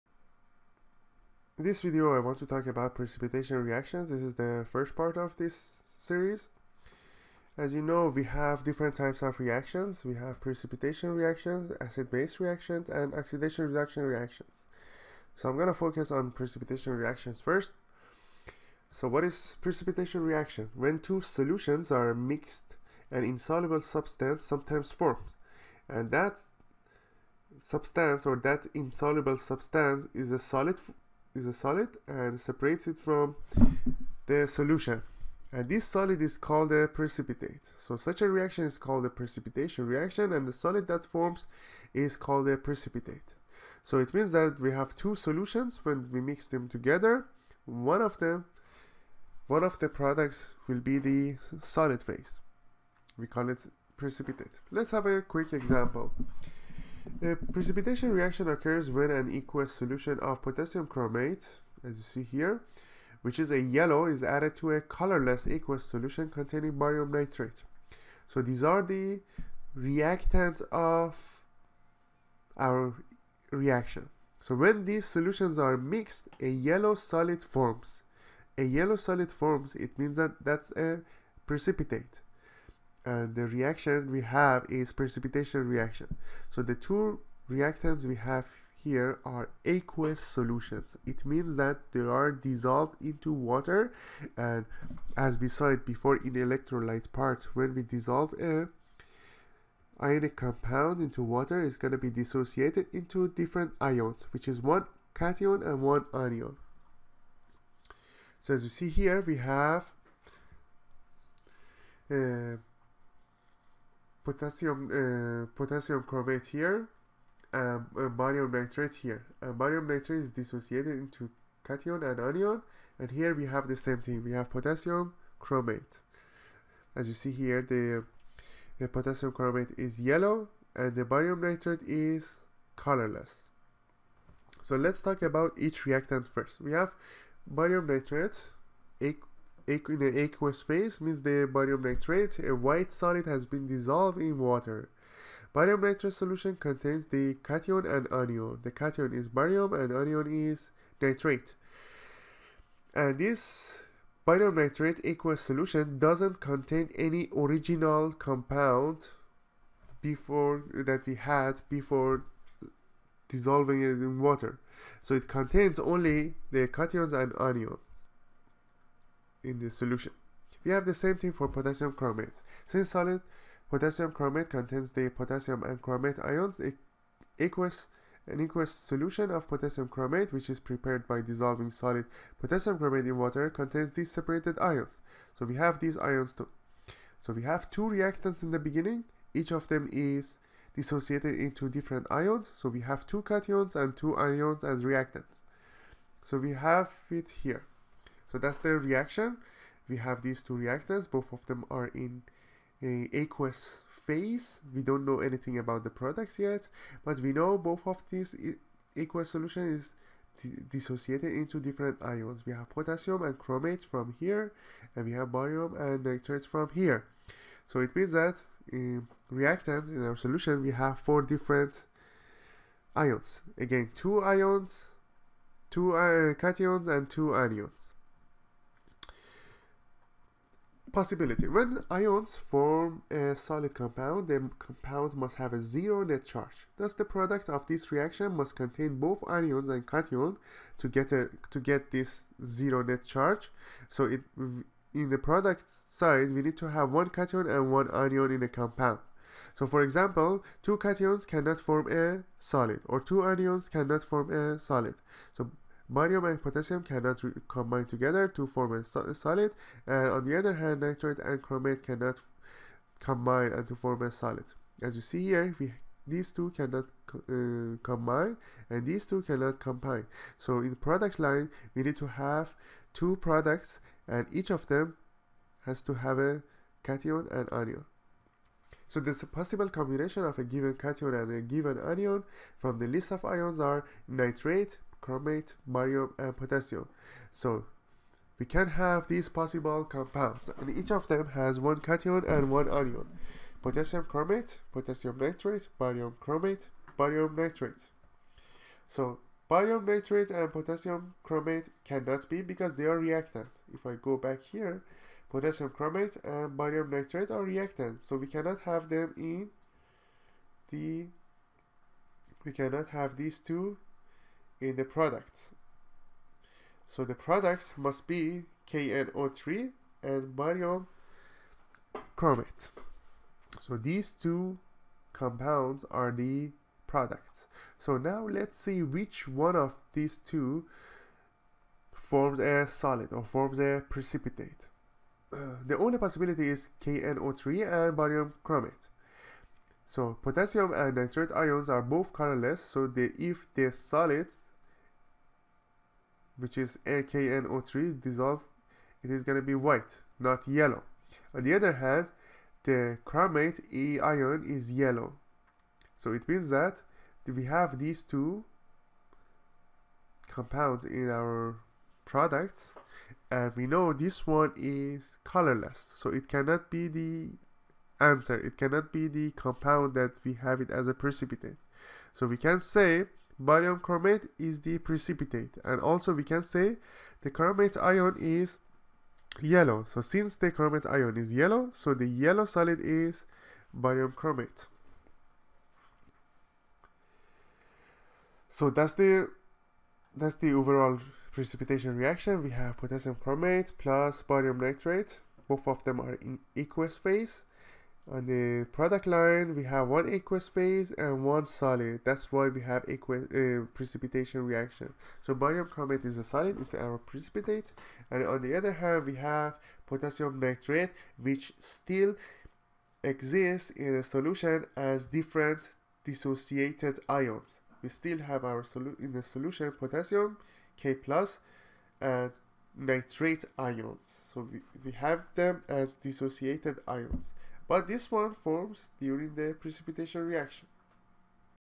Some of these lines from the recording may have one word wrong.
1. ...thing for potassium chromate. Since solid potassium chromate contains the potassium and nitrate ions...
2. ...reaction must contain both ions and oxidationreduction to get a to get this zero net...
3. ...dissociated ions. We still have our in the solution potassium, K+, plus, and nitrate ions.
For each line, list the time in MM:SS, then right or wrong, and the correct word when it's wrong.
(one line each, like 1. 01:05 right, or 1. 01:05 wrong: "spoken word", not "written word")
1. 02:51 wrong: "chromate", not "nitrate"
2. 03:57 wrong: "cation", not "oxidationreduction"
3. 06:56 right.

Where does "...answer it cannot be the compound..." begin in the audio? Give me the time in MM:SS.
06:08.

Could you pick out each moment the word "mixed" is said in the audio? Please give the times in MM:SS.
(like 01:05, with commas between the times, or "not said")
00:22, 01:15.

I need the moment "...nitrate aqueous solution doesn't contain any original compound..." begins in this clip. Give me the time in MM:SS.
02:34.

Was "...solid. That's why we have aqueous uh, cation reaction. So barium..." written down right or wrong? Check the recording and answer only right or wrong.
wrong.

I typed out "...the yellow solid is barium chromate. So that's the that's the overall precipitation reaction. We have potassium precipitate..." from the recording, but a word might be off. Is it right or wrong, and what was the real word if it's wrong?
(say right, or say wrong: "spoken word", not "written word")
wrong: "chromate", not "precipitate".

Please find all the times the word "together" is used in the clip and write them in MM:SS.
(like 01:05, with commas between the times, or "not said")
00:46, 04:17.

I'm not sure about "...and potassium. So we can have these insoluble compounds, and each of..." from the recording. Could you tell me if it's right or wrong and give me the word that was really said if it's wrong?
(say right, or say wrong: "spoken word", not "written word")
wrong: "possible", not "insoluble".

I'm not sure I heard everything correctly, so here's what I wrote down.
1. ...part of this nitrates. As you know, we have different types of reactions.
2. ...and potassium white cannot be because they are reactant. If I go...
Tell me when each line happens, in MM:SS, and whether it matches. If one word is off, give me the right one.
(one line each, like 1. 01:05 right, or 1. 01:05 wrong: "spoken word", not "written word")
1. 00:04 wrong: "series", not "nitrates"
2. 05:00 wrong: "chromate", not "white".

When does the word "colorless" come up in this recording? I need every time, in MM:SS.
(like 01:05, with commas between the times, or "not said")
01:04, 02:12, 05:42, 06:05.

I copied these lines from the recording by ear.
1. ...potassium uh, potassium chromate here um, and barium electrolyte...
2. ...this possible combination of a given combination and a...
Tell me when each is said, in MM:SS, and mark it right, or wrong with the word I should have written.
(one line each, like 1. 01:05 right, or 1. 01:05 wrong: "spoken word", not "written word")
1. 01:54 wrong: "nitrate", not "electrolyte"
2. 04:38 wrong: "cation", not "combination".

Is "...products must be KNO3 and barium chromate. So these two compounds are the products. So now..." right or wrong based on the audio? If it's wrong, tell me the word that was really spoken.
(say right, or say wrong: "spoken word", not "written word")
right.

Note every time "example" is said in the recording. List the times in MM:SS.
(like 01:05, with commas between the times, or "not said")
00:55, 04:09.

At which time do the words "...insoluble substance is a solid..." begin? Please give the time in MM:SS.
00:28.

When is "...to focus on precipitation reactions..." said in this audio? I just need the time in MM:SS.
00:15.